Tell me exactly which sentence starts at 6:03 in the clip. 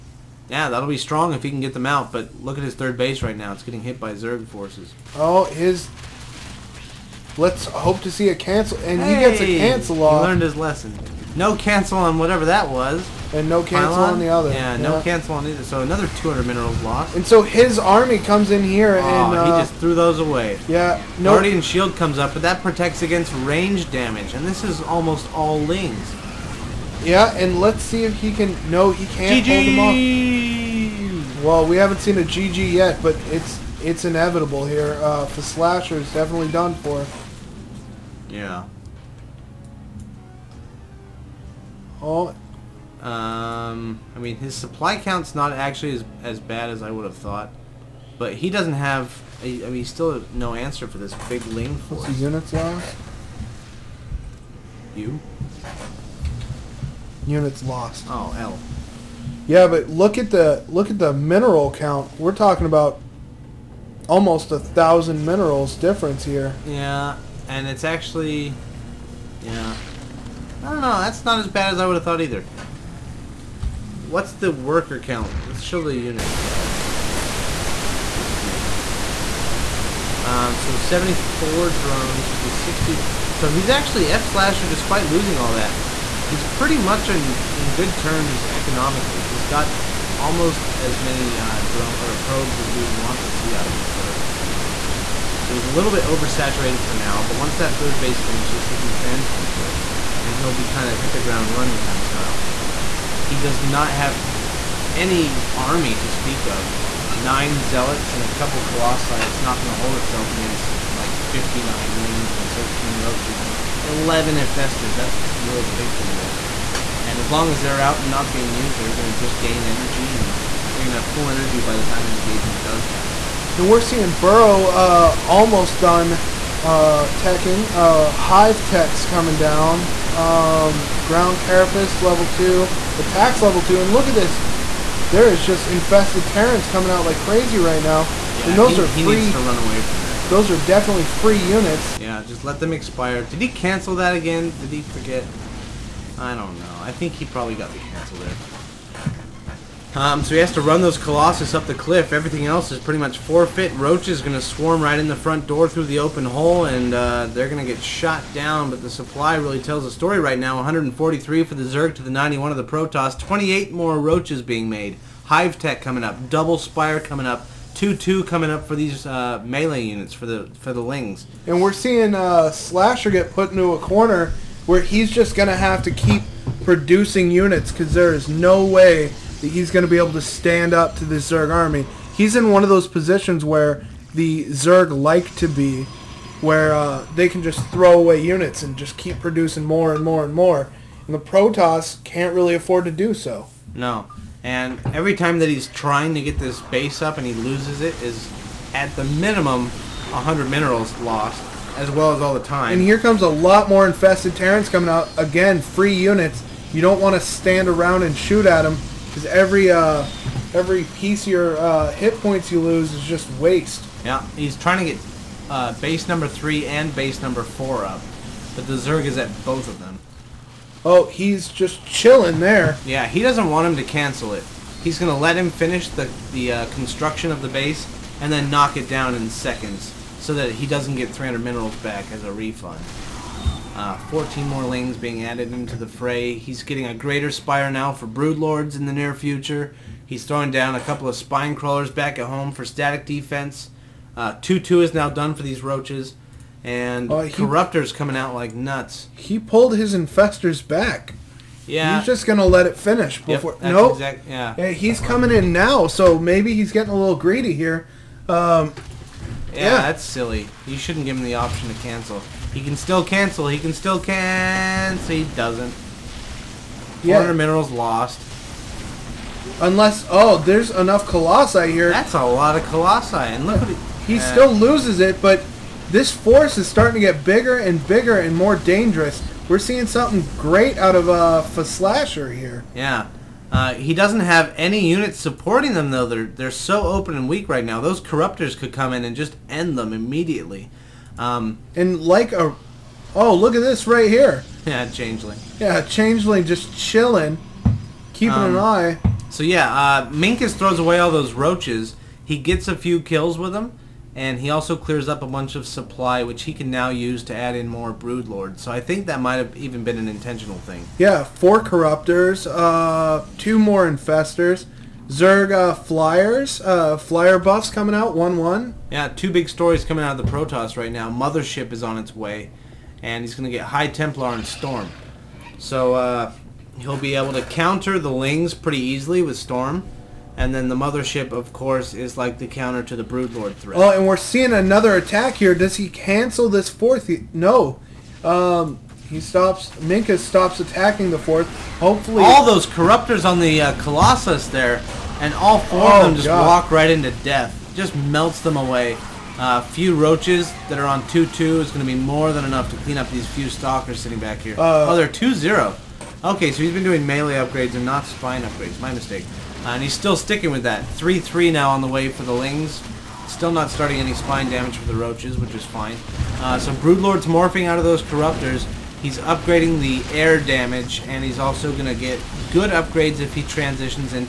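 Still not starting any spine damage for the roaches, which is fine.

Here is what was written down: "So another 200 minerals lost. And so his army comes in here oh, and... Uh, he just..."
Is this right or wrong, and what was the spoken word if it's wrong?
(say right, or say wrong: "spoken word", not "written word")
right.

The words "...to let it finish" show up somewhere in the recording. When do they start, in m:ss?
4:12.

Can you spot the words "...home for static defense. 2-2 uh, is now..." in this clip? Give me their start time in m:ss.
4:02.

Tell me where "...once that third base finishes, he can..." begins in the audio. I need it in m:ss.
1:37.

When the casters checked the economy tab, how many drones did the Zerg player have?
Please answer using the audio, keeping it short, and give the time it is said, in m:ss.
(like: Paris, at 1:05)
74, at 1:20.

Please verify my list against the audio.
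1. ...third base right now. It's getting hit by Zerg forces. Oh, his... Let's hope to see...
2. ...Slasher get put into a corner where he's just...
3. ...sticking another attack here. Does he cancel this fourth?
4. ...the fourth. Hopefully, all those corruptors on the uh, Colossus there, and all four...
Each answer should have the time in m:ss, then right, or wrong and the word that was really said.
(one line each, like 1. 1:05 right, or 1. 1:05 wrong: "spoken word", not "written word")
1. 0:02 right
2. 2:52 right
3. 5:34 wrong: "seeing", not "sticking"
4. 5:41 right.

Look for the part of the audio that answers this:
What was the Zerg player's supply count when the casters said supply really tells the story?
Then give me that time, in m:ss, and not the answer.
2:40.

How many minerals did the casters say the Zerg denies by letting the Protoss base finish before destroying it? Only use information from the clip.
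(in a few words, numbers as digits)
300.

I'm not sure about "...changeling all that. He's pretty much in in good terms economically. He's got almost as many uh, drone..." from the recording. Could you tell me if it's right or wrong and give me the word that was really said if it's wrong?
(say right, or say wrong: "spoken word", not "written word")
wrong: "losing", not "changeling".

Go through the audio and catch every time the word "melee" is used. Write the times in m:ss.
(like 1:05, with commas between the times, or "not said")
2:49, 5:57.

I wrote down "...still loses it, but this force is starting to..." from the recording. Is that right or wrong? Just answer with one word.
right.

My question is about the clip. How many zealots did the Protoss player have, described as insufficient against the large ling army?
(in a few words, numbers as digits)
9.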